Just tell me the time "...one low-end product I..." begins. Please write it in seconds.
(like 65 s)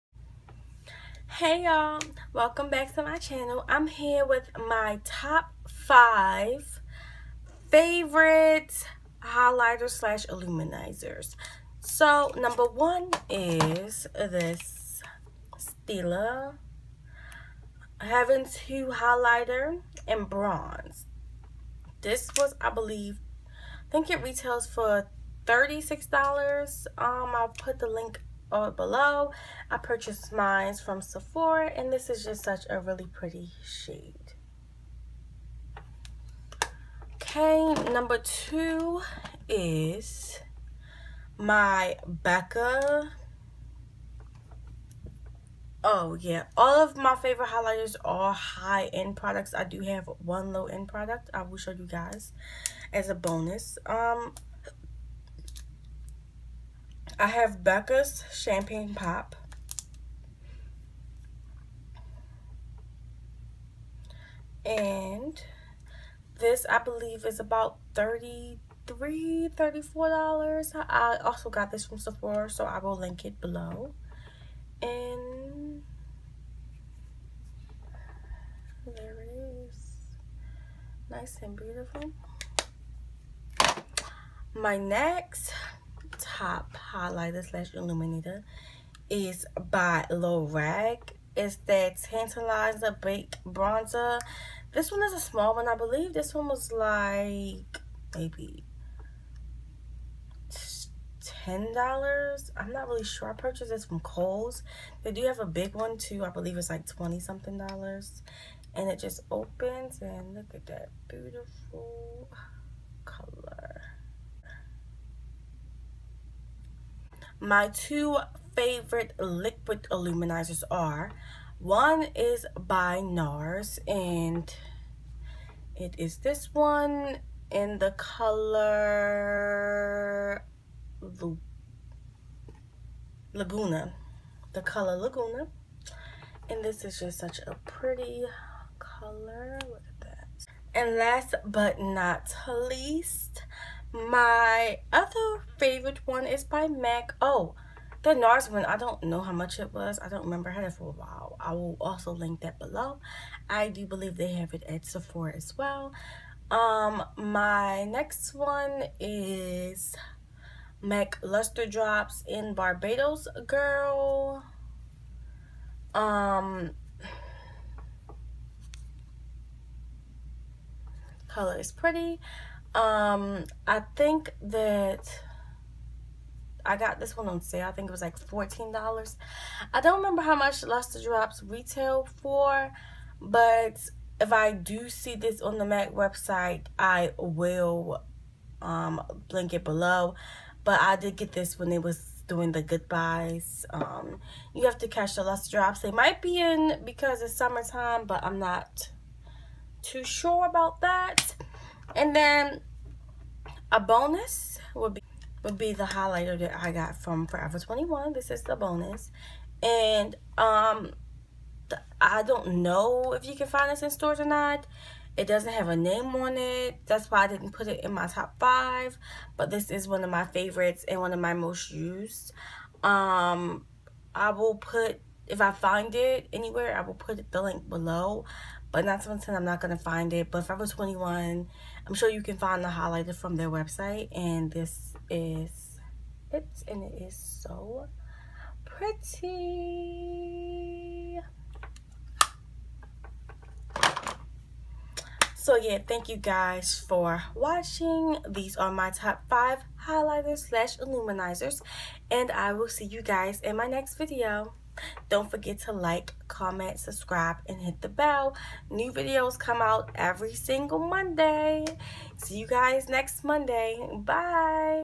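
50 s.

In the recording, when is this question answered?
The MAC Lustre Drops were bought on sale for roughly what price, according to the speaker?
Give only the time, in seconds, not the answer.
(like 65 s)
178 s.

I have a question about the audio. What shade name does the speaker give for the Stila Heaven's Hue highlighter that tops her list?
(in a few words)
Bronze.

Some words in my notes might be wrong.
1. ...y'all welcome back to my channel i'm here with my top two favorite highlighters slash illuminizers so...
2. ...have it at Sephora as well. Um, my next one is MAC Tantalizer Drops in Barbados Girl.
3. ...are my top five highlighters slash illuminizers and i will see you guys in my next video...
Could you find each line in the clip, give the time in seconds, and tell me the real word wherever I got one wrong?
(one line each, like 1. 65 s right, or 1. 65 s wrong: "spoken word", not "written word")
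1. 1 s wrong: "five", not "two"
2. 154 s wrong: "Lustre", not "Tantalizer"
3. 248 s right.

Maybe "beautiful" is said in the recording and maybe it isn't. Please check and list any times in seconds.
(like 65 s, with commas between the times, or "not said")
81 s, 111 s.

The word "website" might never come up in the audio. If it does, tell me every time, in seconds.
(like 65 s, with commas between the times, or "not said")
185 s, 233 s.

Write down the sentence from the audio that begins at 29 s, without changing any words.
I purchased mine from Sephora and this is just such a really pretty shade.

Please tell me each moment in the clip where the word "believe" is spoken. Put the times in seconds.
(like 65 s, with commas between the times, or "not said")
22 s, 66 s, 95 s, 106 s, 153 s.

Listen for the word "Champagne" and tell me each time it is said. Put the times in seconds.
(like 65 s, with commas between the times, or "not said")
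58 s.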